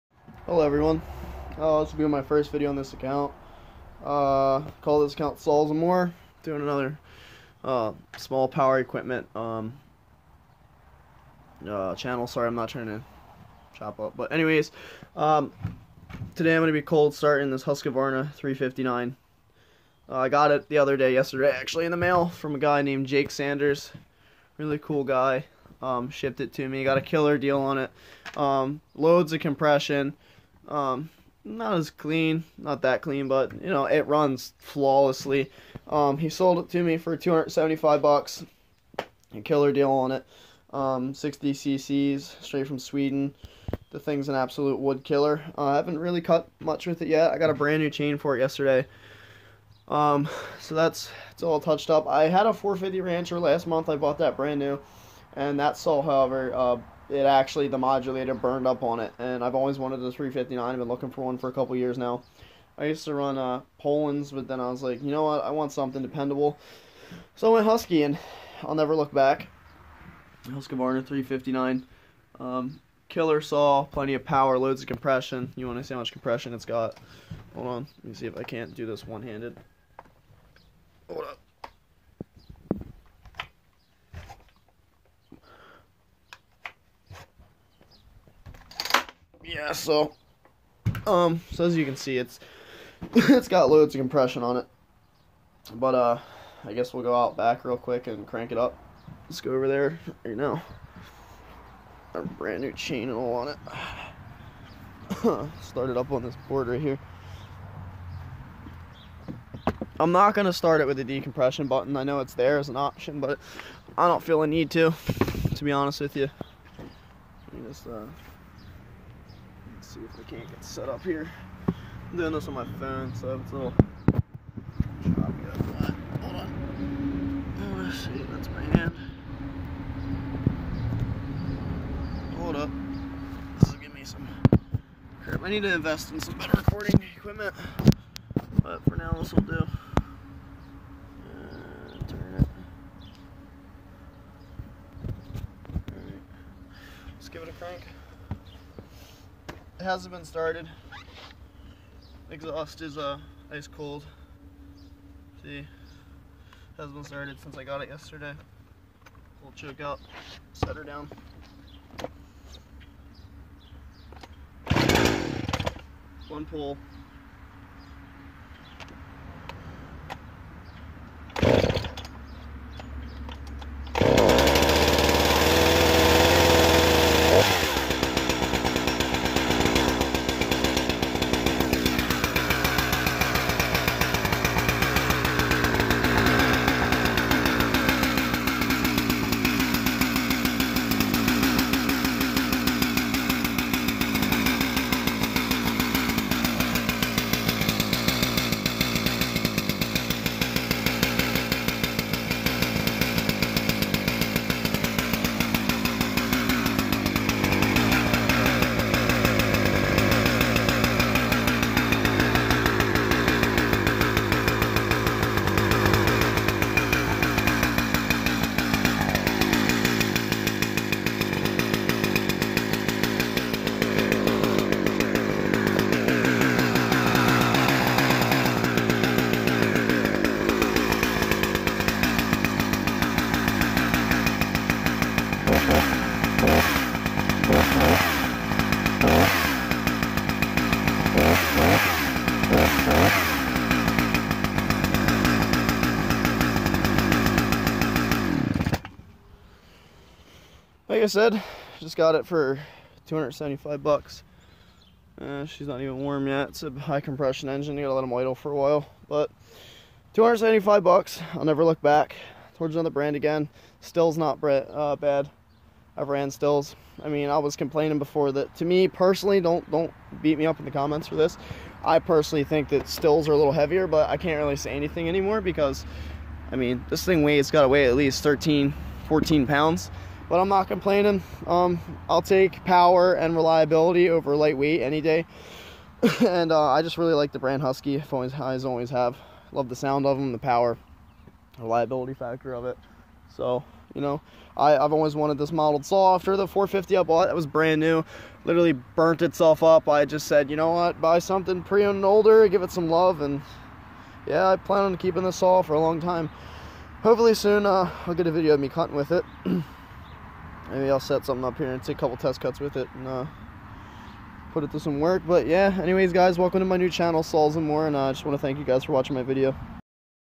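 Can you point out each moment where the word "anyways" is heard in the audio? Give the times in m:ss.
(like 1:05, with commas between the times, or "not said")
0:14, 5:15.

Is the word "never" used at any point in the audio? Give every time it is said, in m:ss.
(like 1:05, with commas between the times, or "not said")
1:08, 4:21.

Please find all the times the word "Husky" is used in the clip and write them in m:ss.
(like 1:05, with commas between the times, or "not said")
1:07, 4:47.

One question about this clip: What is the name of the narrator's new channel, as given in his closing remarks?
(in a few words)
Saws and More.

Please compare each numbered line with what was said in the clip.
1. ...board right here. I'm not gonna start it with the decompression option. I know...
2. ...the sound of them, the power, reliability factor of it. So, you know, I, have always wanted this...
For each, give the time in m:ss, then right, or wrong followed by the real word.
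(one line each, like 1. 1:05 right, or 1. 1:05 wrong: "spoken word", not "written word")
1. 1:46 wrong: "button", not "option"
2. 4:49 right.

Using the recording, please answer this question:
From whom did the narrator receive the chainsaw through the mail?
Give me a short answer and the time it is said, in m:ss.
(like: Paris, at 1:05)
Jake Sanders, at 0:23.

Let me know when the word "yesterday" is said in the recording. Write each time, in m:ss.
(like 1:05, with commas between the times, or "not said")
0:21, 0:48, 2:37.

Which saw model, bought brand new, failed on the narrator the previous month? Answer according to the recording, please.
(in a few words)
450 Rancher.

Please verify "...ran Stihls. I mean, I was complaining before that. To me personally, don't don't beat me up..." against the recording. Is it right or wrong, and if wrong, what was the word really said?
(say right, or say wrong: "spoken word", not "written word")
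right.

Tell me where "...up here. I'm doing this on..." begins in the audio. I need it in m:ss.
2:00.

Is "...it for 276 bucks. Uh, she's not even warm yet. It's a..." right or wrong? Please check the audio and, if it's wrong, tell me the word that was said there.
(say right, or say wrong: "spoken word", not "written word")
wrong: "275", not "276".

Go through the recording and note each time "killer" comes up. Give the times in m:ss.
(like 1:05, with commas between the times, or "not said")
0:27, 0:39, 0:45, 1:13.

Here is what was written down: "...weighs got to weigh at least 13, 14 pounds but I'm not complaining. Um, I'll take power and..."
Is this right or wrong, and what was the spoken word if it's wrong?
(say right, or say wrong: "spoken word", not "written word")
right.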